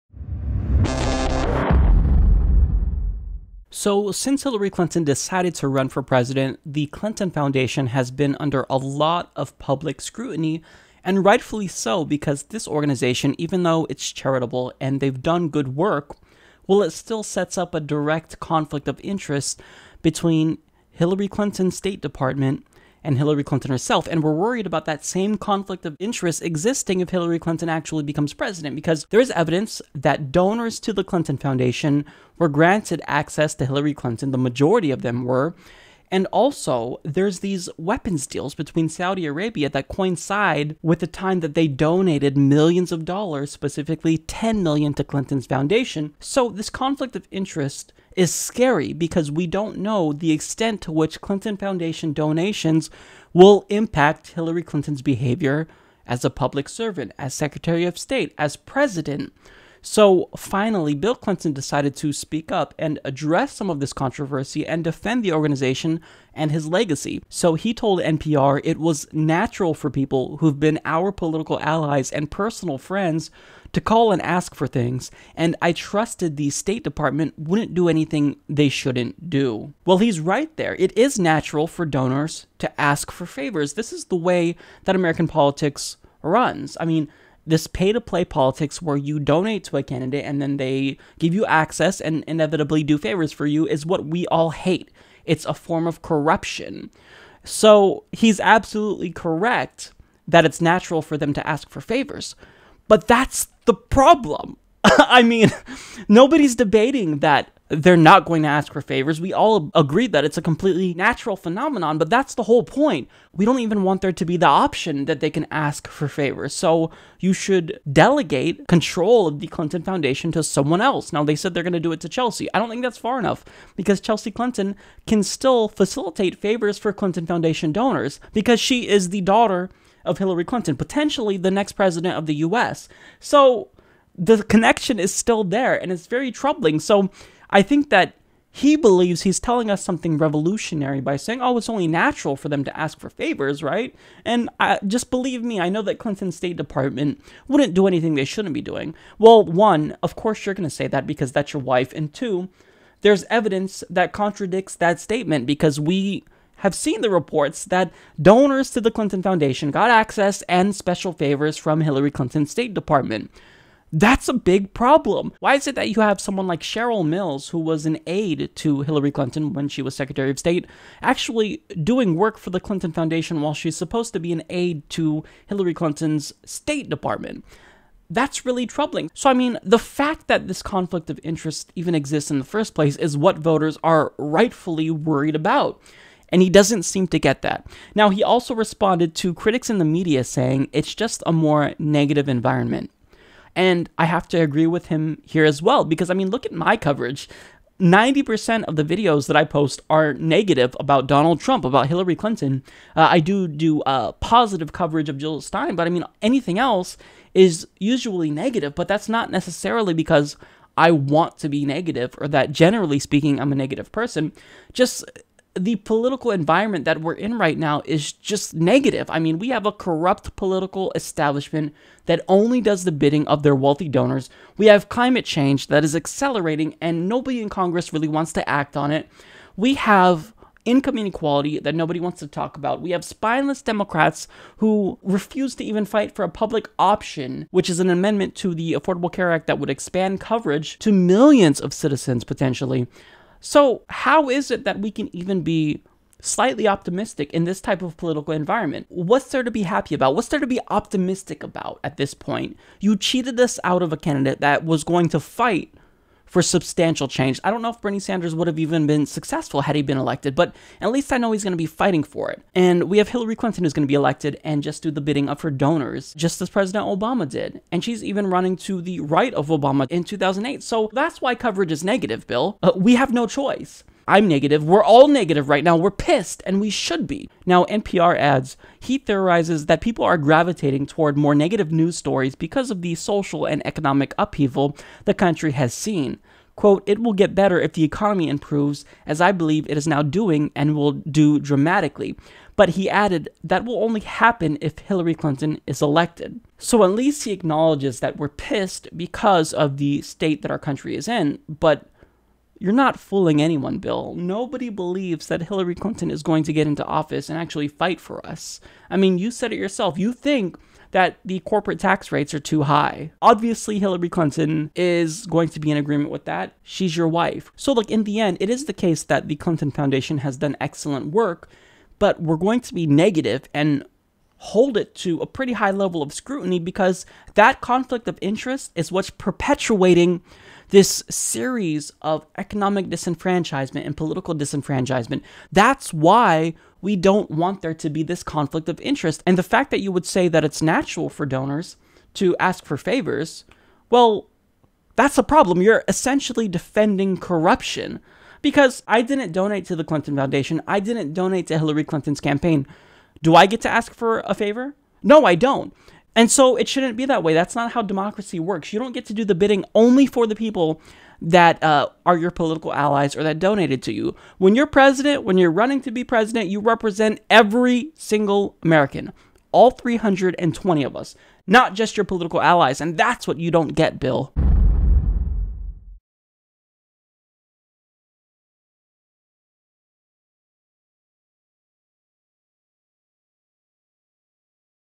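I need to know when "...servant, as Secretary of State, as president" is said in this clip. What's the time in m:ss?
0:56.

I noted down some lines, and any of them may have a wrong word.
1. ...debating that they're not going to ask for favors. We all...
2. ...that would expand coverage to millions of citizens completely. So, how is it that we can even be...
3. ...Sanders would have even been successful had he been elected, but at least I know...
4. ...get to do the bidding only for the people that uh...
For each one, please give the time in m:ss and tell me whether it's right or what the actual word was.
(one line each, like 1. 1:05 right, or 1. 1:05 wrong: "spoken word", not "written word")
1. 1:46 right
2. 3:59 wrong: "potentially", not "completely"
3. 4:17 right
4. 5:58 right.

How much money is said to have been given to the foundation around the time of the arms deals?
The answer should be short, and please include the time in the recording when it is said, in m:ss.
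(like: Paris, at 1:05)
10 million, at 0:44.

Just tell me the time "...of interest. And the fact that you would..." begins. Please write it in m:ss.
5:38.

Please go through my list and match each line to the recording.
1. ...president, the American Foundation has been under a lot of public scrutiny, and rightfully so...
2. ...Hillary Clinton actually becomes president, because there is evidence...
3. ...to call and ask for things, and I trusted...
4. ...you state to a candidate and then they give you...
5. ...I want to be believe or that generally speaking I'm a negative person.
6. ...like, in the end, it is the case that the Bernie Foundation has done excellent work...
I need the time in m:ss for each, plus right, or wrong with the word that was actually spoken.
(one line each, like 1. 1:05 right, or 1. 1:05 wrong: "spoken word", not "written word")
1. 0:06 wrong: "Clinton", not "American"
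2. 0:27 right
3. 1:13 right
4. 1:28 wrong: "donate", not "state"
5. 3:30 wrong: "negative", not "believe"
6. 5:17 wrong: "Clinton", not "Bernie".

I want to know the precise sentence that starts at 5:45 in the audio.
You're essentially defending corruption because I didn't donate to the Clinton Foundation, I didn't donate to Hillary Clinton's campaign.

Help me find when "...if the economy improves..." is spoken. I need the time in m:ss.
4:47.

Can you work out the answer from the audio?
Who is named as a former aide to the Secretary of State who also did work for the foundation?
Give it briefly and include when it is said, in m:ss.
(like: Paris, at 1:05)
Cheryl Mills, at 2:46.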